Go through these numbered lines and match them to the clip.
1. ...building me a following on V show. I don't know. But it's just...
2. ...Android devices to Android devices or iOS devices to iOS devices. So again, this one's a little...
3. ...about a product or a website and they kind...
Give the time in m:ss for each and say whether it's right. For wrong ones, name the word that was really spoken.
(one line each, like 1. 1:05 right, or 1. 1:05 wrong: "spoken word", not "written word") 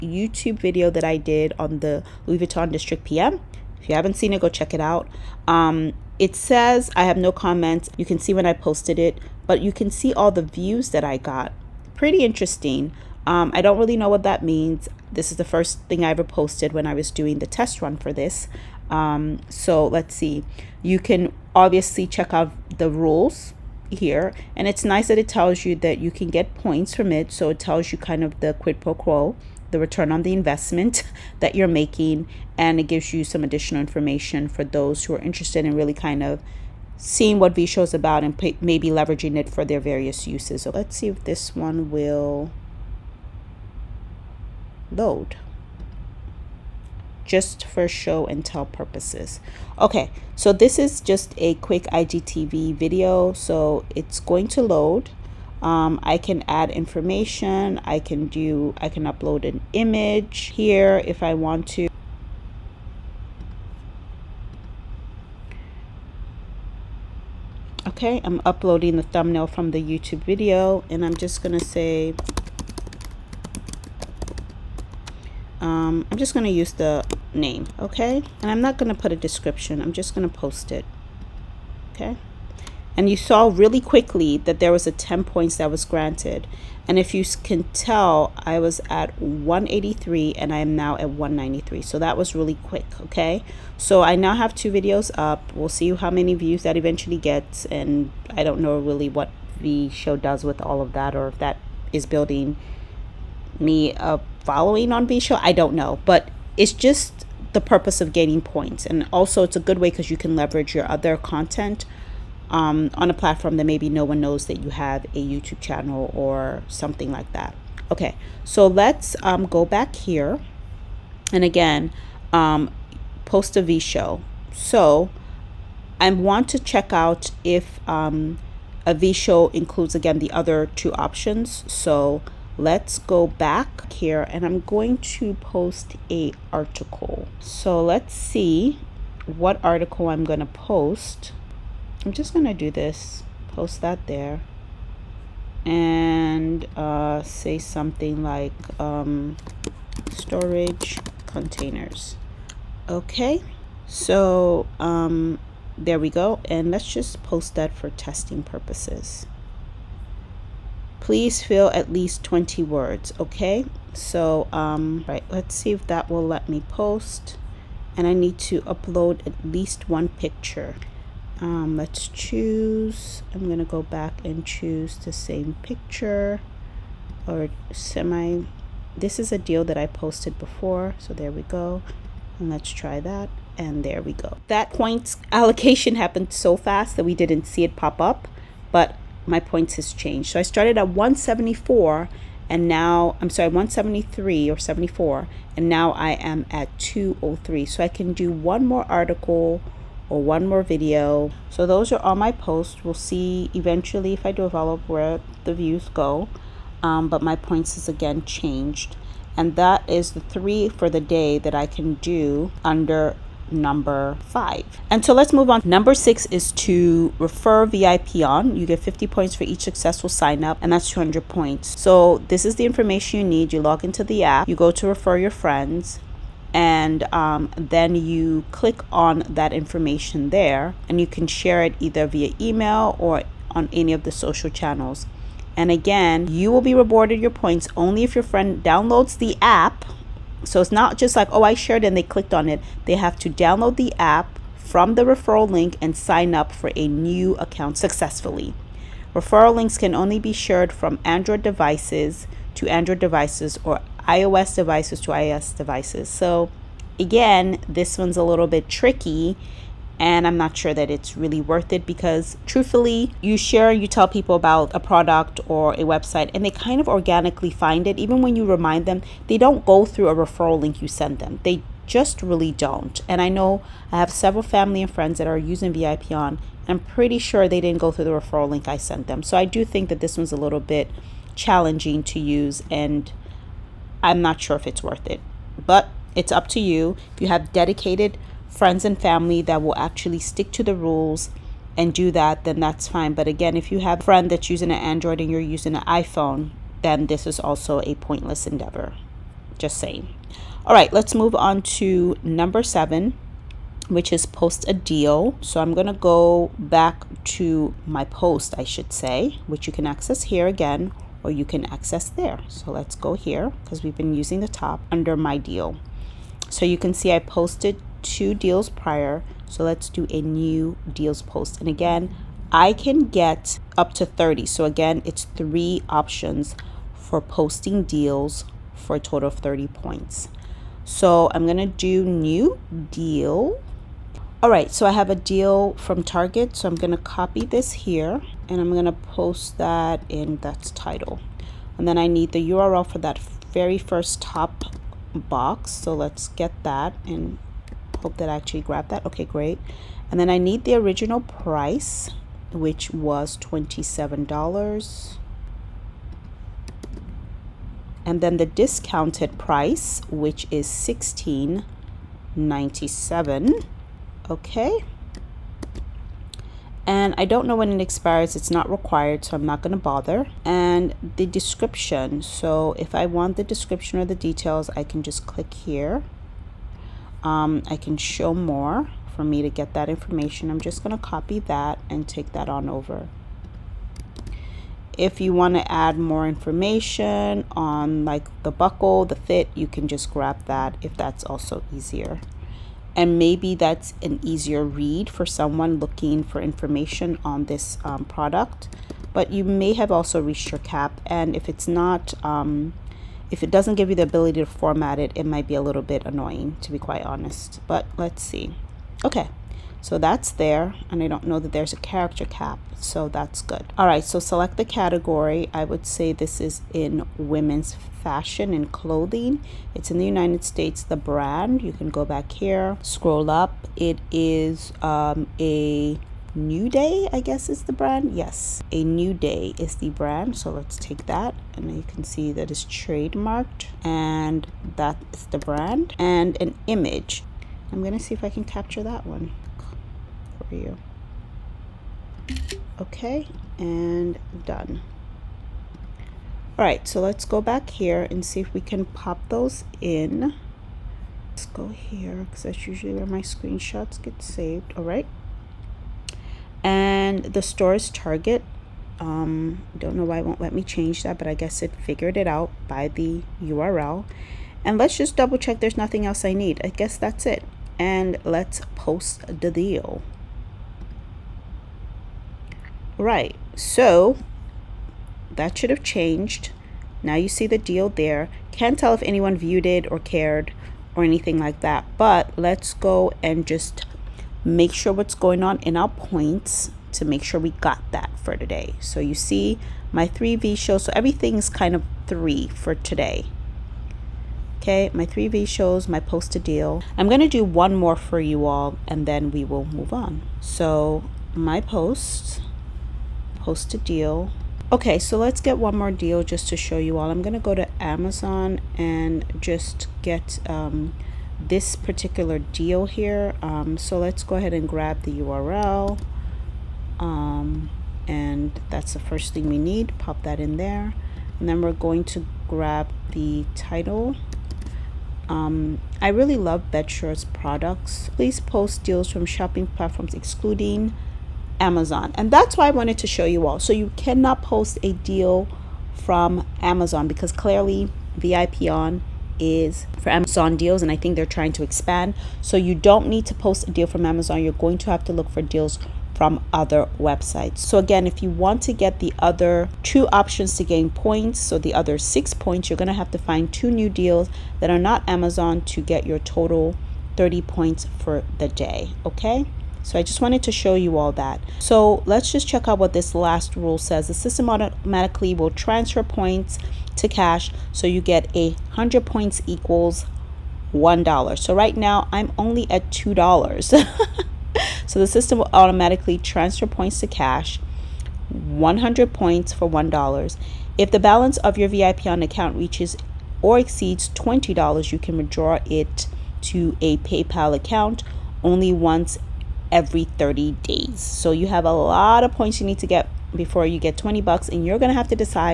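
1. 1:42 right
2. 4:11 right
3. 4:24 right.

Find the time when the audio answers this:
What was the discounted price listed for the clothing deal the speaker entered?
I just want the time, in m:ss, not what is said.
6:00.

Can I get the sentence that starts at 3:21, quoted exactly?
So those are all my posts.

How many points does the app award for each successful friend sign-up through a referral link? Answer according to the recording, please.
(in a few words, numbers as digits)
50 points.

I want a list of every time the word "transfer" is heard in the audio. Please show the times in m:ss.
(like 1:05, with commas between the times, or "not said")
9:25, 9:36.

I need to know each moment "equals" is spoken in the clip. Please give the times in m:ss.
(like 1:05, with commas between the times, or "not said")
9:29.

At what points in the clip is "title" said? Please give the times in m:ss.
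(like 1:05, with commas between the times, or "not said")
5:40, 8:43.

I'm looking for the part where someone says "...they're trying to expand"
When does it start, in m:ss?
9:01.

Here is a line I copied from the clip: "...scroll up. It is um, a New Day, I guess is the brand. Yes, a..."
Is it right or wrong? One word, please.
right.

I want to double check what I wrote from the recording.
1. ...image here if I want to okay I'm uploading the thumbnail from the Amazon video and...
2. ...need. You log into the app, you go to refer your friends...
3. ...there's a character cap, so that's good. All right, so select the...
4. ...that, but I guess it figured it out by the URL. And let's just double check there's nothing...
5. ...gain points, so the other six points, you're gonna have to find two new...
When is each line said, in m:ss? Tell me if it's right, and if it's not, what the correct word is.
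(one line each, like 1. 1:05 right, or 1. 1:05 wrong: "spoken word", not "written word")
1. 0:59 wrong: "YouTube", not "Amazon"
2. 3:43 right
3. 6:51 right
4. 7:41 right
5. 9:10 right.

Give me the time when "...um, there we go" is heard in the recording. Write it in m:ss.
2:34.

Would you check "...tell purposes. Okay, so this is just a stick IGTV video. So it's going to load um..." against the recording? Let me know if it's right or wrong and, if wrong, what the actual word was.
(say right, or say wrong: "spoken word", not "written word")
wrong: "quick", not "stick".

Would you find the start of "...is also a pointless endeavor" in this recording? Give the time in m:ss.
4:57.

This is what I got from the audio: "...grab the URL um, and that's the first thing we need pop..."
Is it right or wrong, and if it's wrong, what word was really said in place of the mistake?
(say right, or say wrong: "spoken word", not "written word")
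right.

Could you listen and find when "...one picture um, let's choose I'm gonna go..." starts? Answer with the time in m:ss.
2:49.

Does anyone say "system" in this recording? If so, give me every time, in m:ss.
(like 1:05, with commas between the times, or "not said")
9:24, 9:35.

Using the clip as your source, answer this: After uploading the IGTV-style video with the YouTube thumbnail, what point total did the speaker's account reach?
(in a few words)
193.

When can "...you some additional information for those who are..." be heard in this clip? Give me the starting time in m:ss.
0:33.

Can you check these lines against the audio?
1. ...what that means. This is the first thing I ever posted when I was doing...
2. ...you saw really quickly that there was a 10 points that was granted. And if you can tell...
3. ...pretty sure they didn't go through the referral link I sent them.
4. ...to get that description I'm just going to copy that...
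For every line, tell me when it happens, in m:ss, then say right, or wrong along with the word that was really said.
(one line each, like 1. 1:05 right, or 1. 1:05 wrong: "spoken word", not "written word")
1. 0:14 right
2. 1:23 right
3. 4:36 right
4. 6:19 wrong: "information", not "description".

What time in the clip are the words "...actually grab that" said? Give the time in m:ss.
5:48.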